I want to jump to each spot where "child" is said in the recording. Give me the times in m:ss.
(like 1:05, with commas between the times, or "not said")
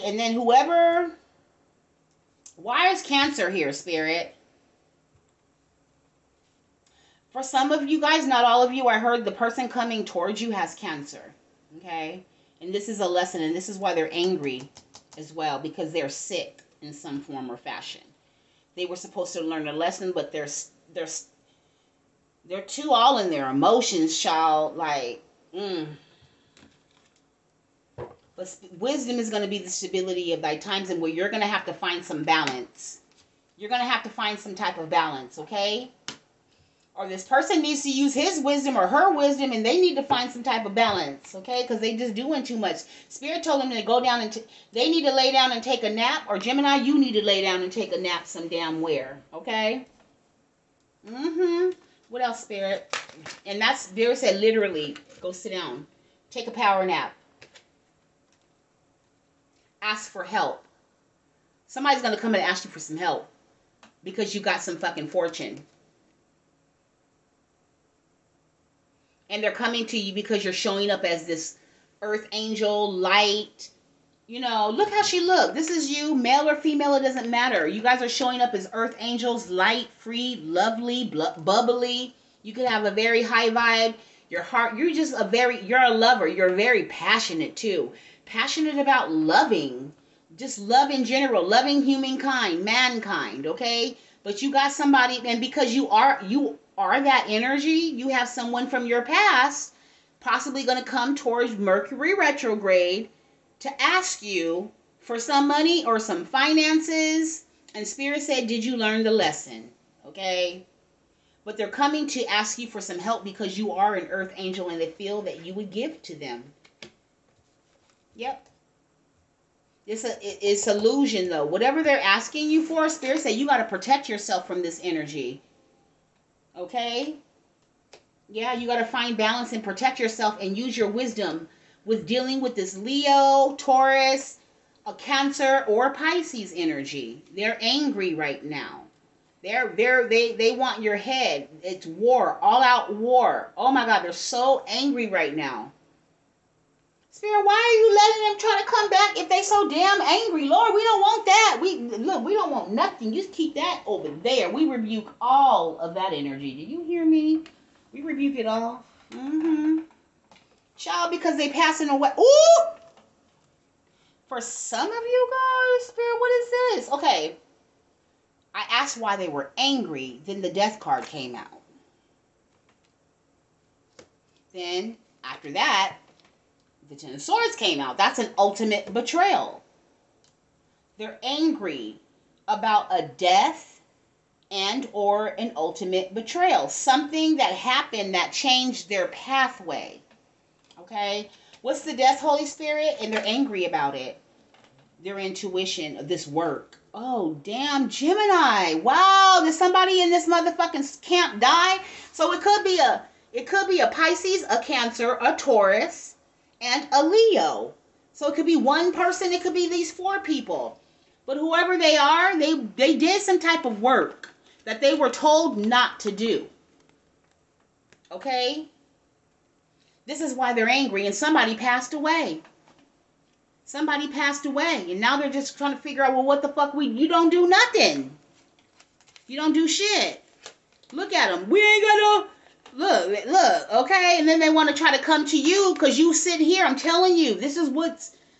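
0:24, 2:40.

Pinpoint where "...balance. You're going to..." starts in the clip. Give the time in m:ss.
0:32.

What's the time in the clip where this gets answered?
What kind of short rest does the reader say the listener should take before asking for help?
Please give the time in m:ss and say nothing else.
0:56.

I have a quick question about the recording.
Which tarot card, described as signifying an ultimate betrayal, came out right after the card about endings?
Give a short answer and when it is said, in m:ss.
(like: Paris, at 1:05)
Ten of Swords, at 2:56.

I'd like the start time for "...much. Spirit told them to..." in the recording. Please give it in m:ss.
0:42.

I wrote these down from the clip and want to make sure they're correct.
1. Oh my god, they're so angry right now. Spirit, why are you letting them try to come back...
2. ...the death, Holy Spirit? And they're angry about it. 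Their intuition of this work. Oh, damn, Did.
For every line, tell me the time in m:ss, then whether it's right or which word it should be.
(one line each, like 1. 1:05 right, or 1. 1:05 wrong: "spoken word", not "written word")
1. 2:23 right
2. 3:11 wrong: "Gemini", not "Did".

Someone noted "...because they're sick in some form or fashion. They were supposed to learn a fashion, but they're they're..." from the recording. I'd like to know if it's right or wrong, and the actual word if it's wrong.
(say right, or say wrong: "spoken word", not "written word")
wrong: "lesson", not "fashion".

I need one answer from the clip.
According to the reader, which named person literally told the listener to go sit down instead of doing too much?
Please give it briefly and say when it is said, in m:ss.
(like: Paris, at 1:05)
Vera, at 0:53.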